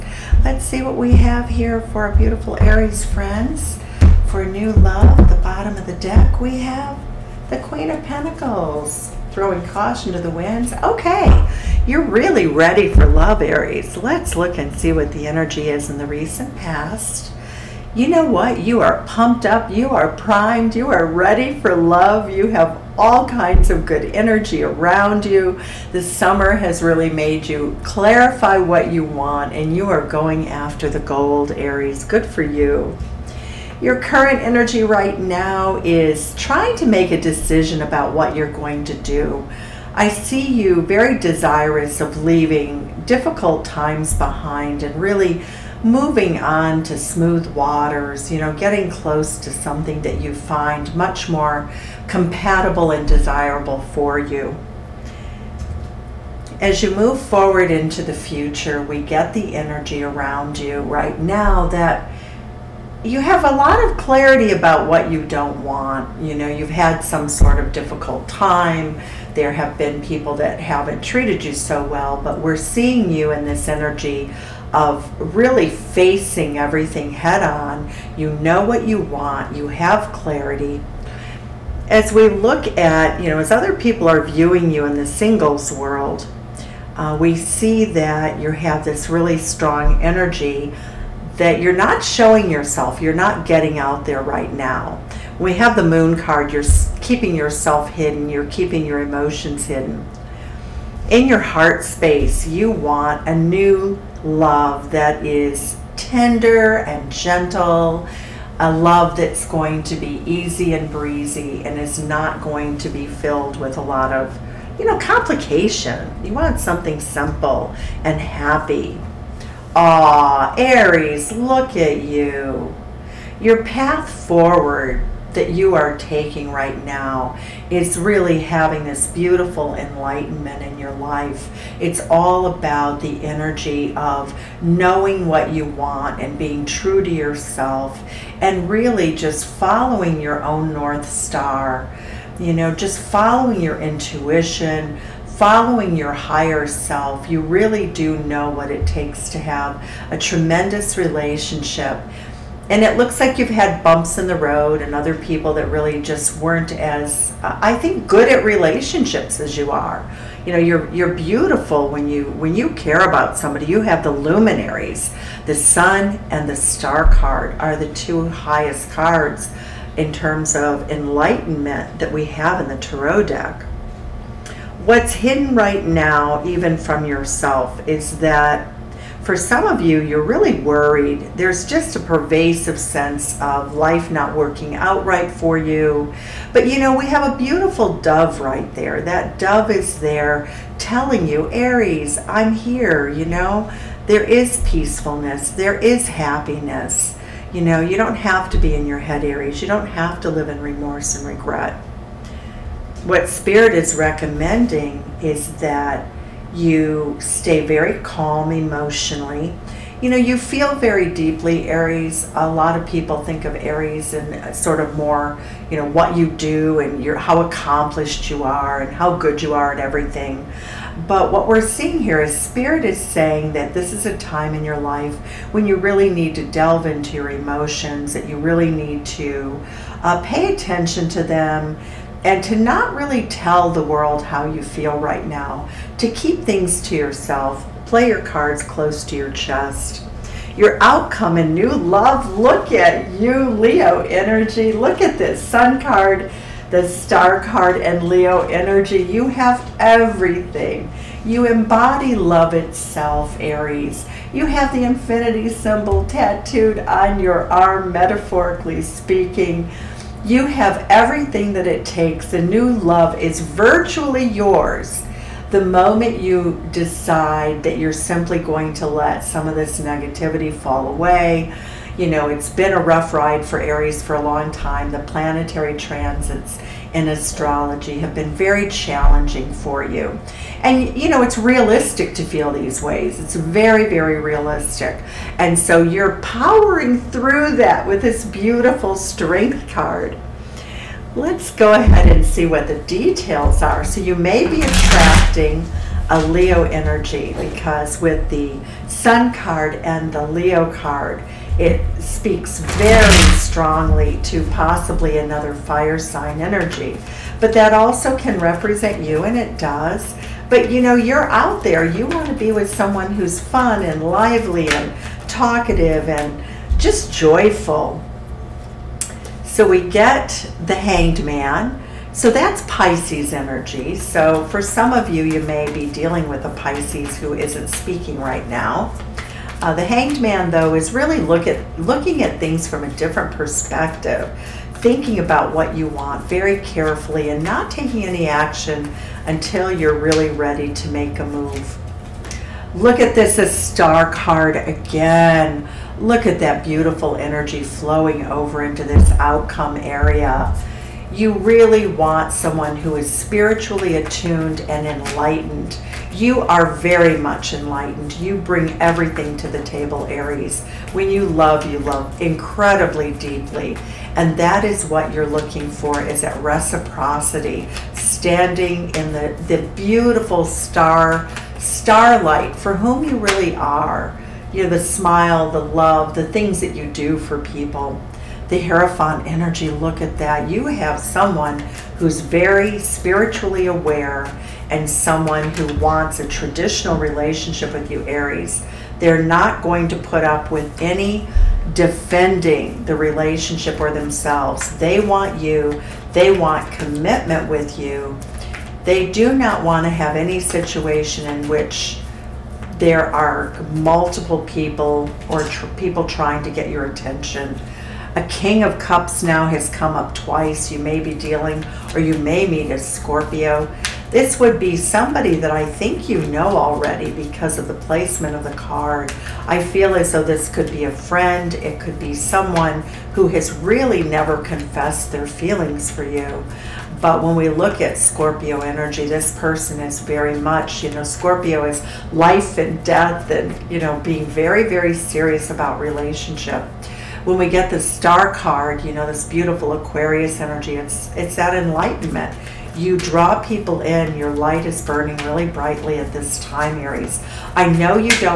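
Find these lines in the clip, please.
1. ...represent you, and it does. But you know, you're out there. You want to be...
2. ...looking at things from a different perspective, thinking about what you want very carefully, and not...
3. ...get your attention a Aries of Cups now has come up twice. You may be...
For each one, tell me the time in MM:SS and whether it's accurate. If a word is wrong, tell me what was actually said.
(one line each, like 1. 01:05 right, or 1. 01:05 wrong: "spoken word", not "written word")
1. 05:08 right
2. 05:31 right
3. 06:46 wrong: "King", not "Aries".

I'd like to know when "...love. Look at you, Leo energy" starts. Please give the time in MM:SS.
04:01.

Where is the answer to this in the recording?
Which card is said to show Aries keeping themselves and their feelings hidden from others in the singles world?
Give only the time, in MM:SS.
01:35.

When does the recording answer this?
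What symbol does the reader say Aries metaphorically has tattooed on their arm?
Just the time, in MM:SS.
04:14.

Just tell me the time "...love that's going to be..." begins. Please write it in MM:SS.
01:48.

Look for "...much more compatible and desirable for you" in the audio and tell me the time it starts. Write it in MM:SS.
00:50.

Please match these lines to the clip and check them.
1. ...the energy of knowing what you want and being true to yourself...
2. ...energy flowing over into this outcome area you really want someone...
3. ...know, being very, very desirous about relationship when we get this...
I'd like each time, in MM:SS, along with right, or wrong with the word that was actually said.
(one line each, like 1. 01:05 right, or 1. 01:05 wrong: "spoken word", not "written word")
1. 02:12 right
2. 05:47 right
3. 07:13 wrong: "serious", not "desirous".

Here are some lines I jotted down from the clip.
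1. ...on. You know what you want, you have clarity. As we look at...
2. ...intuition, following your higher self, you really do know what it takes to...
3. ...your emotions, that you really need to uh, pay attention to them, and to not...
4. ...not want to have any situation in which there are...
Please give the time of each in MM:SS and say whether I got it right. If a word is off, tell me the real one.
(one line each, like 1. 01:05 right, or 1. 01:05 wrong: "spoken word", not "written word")
1. 01:17 right
2. 02:23 right
3. 03:47 right
4. 06:39 right.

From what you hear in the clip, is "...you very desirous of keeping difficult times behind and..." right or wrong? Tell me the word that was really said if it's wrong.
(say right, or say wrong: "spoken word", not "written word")
wrong: "leaving", not "keeping".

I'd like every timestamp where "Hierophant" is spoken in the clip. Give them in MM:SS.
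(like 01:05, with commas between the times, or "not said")
06:18.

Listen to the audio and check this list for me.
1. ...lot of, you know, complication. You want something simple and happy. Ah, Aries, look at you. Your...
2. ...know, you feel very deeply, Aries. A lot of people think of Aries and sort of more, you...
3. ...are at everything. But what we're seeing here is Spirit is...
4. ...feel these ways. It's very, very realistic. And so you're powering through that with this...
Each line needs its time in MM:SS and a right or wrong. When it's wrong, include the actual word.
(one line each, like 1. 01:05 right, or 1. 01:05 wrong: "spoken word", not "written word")
1. 01:53 right
2. 03:30 right
3. 03:39 right
4. 04:42 right.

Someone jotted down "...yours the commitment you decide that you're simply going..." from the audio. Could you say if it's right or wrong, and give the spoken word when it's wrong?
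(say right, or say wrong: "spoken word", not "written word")
wrong: "moment", not "commitment".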